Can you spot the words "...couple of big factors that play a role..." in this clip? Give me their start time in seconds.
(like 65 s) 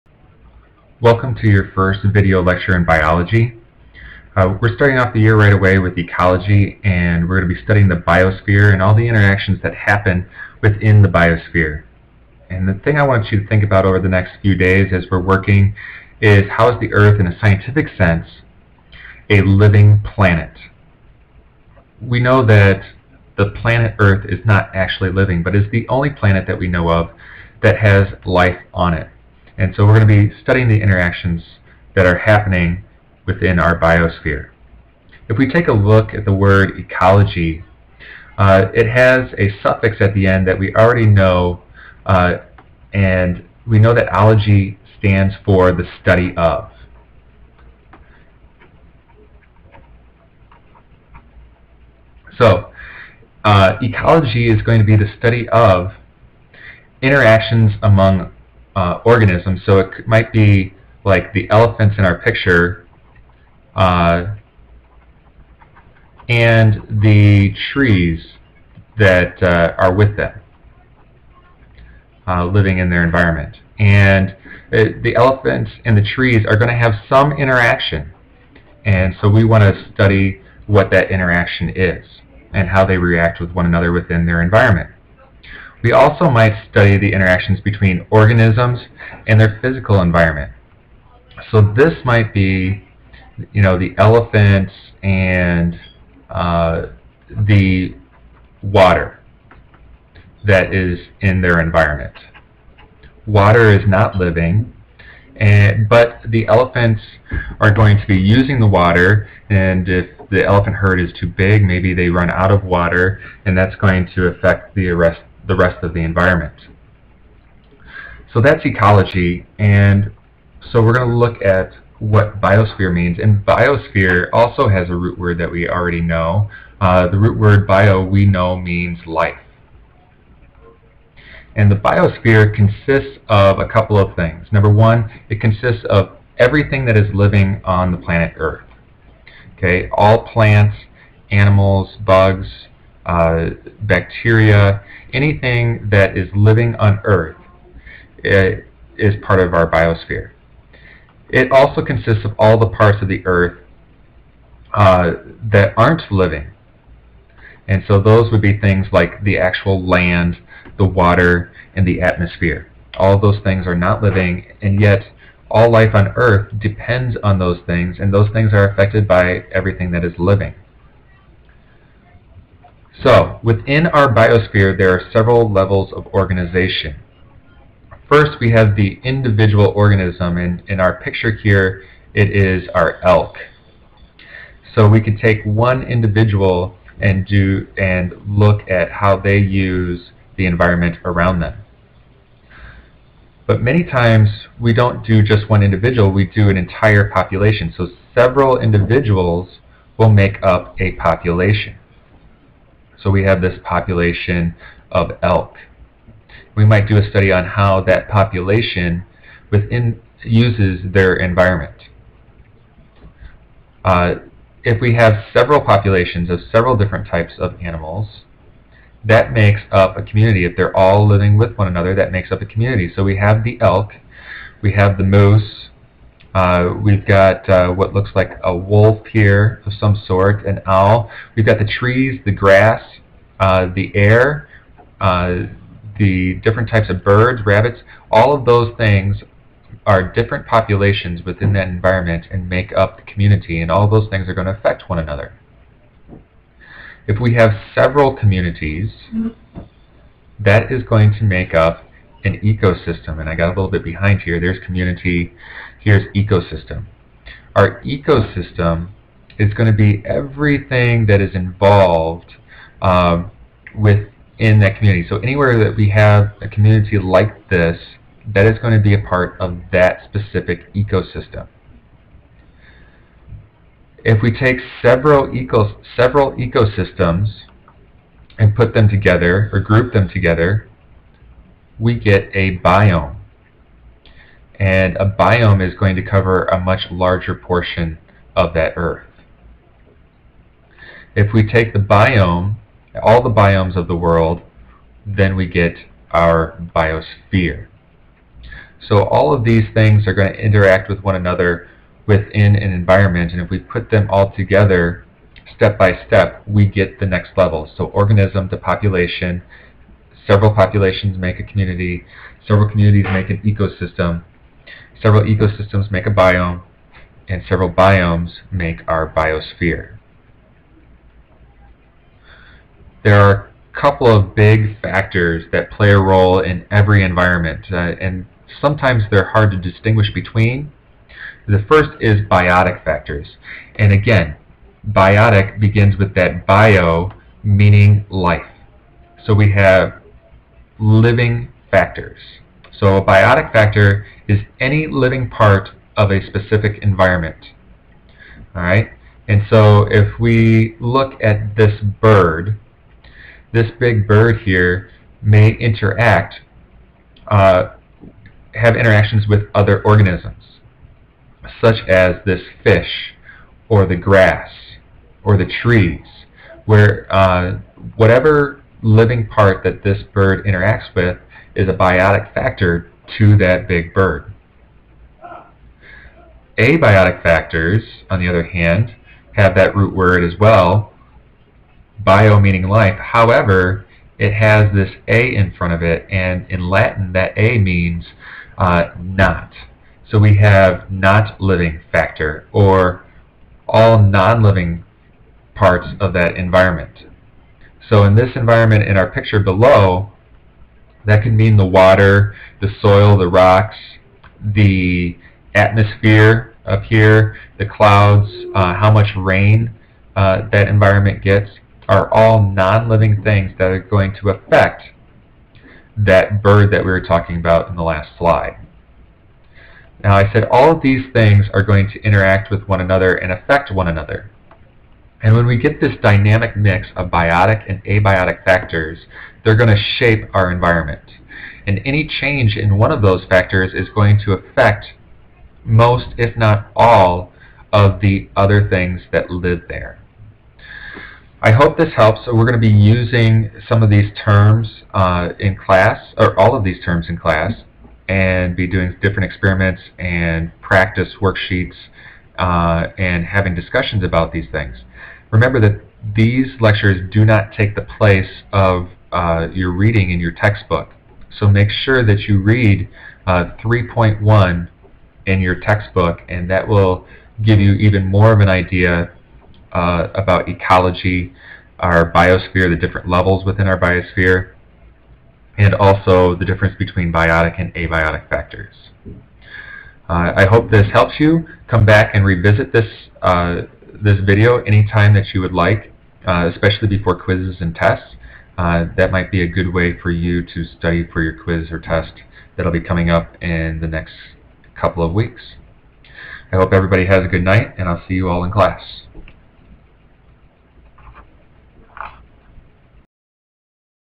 323 s.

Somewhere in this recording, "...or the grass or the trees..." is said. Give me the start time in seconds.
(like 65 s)
363 s.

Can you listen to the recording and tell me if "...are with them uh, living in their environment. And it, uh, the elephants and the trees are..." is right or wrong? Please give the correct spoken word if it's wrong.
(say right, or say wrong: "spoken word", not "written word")
right.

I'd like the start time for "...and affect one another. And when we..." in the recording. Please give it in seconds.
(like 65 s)
423 s.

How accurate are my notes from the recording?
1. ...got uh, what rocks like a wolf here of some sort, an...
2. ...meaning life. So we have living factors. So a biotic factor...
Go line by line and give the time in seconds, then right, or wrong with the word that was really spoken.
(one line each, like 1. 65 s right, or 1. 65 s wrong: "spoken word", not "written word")
1. 227 s wrong: "looks", not "rocks"
2. 337 s right.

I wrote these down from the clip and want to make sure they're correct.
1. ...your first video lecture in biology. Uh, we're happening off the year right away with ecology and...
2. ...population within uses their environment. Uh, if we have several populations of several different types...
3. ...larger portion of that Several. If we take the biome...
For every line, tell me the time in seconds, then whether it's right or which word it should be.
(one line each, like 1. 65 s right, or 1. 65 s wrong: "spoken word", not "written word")
1. 1 s wrong: "starting", not "happening"
2. 208 s right
3. 286 s wrong: "Earth", not "Several".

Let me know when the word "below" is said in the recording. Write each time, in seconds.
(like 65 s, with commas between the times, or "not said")
399 s.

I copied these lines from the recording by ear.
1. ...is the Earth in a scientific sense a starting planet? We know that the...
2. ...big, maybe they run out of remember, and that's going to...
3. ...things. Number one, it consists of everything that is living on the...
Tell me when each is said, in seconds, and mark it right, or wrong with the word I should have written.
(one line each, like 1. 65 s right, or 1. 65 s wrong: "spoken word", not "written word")
1. 16 s wrong: "living", not "starting"
2. 111 s wrong: "water", not "remember"
3. 134 s right.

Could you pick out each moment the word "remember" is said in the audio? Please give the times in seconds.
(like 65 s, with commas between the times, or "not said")
455 s.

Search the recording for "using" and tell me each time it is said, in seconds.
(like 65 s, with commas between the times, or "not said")
108 s, 442 s.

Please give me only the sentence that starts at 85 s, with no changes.
We also might study the interactions between organisms and their physical environment.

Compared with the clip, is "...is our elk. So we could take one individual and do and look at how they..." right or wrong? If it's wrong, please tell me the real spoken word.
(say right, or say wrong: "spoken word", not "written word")
right.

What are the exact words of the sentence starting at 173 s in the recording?
So, within our biosphere, there are several levels of organization.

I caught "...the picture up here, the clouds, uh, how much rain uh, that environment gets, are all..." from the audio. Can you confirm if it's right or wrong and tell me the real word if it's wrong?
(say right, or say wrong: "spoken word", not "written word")
wrong: "atmosphere", not "picture".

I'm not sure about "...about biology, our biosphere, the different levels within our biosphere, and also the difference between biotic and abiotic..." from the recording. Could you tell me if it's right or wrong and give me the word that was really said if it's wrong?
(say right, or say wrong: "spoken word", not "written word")
wrong: "ecology", not "biology".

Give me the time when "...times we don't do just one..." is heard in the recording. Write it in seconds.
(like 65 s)
193 s.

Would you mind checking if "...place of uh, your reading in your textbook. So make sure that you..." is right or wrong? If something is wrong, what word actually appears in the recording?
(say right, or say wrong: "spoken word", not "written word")
right.